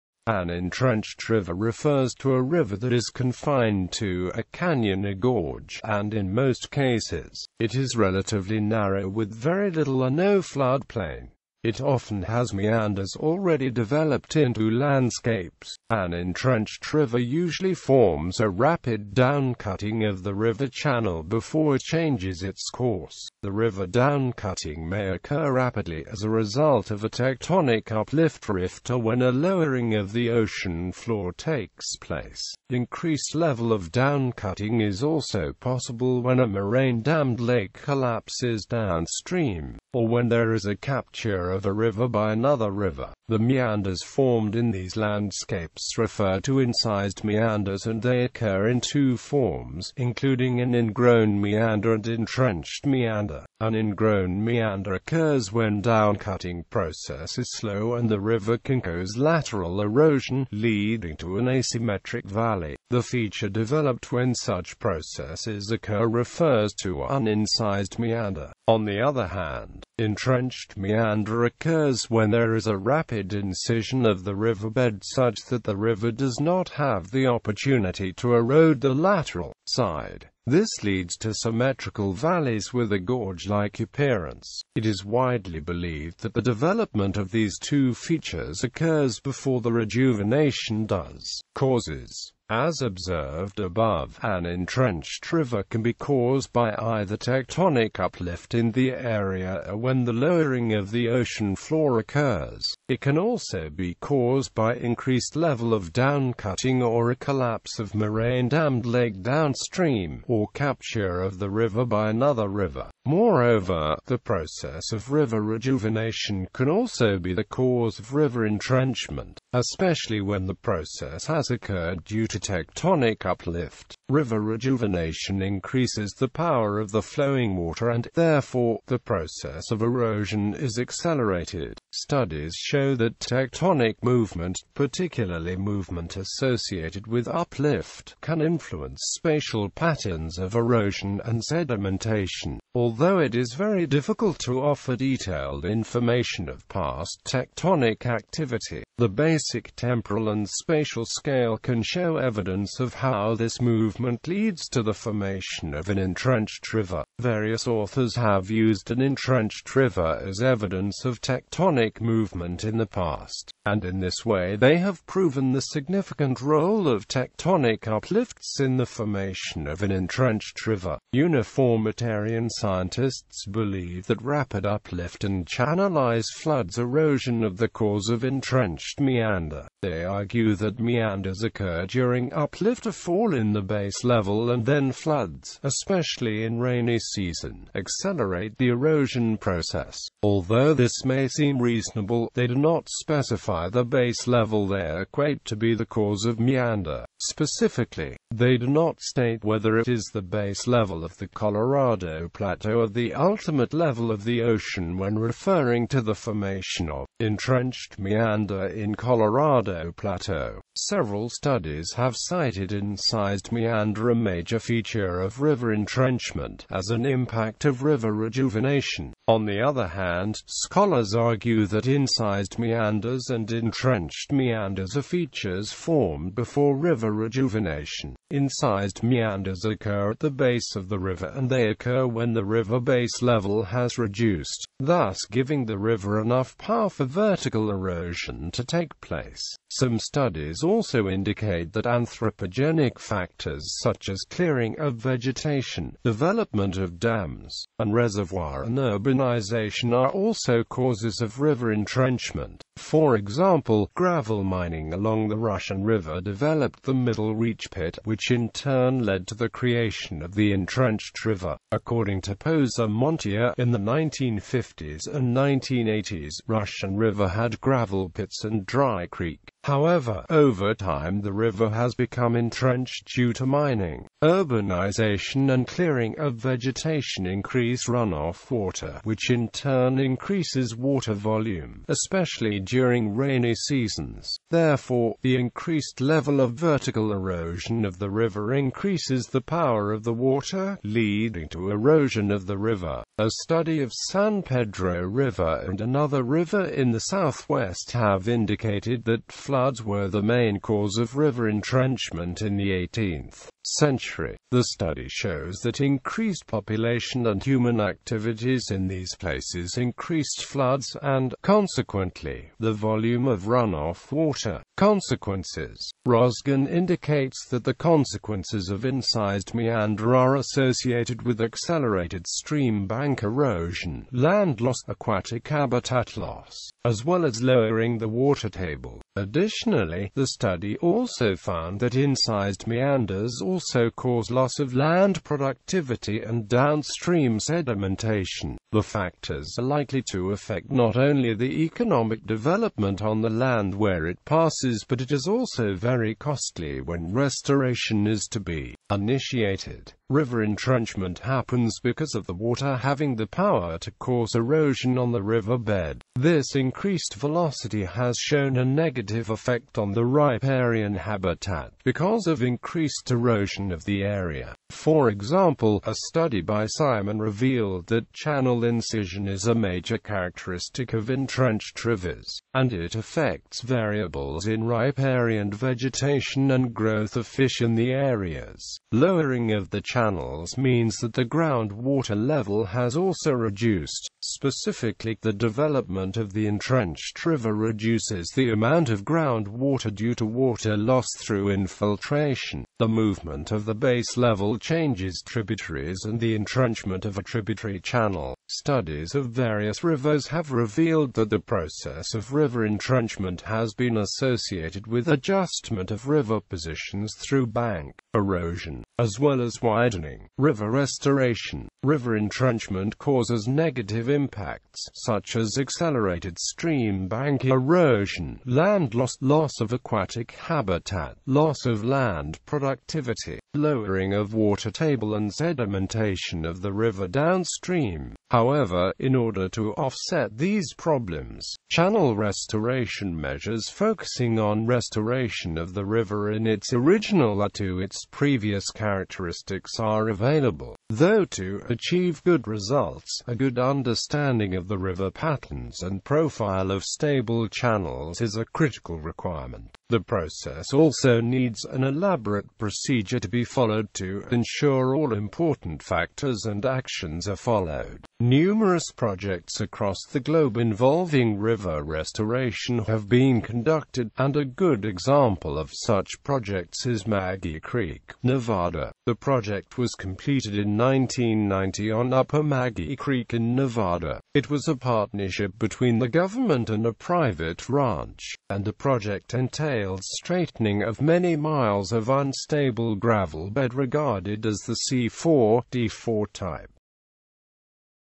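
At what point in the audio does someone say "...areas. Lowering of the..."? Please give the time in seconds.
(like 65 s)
377 s.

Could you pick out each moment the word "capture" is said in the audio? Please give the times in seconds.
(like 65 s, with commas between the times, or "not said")
40 s, 110 s.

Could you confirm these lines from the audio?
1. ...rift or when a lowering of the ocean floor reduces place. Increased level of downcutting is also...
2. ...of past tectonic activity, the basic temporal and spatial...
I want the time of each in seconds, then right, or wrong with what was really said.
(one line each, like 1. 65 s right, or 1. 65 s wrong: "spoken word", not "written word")
1. 28 s wrong: "takes", not "reduces"
2. 146 s right.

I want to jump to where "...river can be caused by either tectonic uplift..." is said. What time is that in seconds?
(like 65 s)
95 s.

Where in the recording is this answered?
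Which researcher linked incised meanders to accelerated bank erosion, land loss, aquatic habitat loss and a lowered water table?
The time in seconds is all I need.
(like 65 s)
316 s.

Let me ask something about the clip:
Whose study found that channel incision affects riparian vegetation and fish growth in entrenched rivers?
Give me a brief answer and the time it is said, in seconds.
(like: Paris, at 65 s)
Simon, at 366 s.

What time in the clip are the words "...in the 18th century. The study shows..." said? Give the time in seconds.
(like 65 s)
302 s.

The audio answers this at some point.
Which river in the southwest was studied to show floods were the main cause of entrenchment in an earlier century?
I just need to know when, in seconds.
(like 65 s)
294 s.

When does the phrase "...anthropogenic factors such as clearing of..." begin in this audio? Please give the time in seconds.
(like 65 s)
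241 s.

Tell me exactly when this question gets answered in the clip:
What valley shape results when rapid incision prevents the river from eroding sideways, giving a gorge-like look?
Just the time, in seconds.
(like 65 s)
81 s.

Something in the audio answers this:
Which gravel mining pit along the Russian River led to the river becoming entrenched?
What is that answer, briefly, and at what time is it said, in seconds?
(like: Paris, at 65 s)
Middle Reach Pit, at 256 s.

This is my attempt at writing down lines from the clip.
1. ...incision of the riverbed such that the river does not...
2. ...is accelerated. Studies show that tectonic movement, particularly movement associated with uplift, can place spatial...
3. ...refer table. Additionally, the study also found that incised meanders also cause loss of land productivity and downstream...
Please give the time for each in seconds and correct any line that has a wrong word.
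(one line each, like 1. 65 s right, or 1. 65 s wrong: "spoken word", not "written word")
1. 73 s right
2. 130 s wrong: "influence", not "place"
3. 328 s wrong: "water", not "refer".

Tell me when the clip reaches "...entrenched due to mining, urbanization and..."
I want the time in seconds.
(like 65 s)
272 s.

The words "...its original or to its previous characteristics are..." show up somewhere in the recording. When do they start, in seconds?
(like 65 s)
436 s.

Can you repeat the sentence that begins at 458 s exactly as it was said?
Numerous projects across the globe involving river restoration have been conducted, and a good example of such projects is Maggie Creek, Nevada.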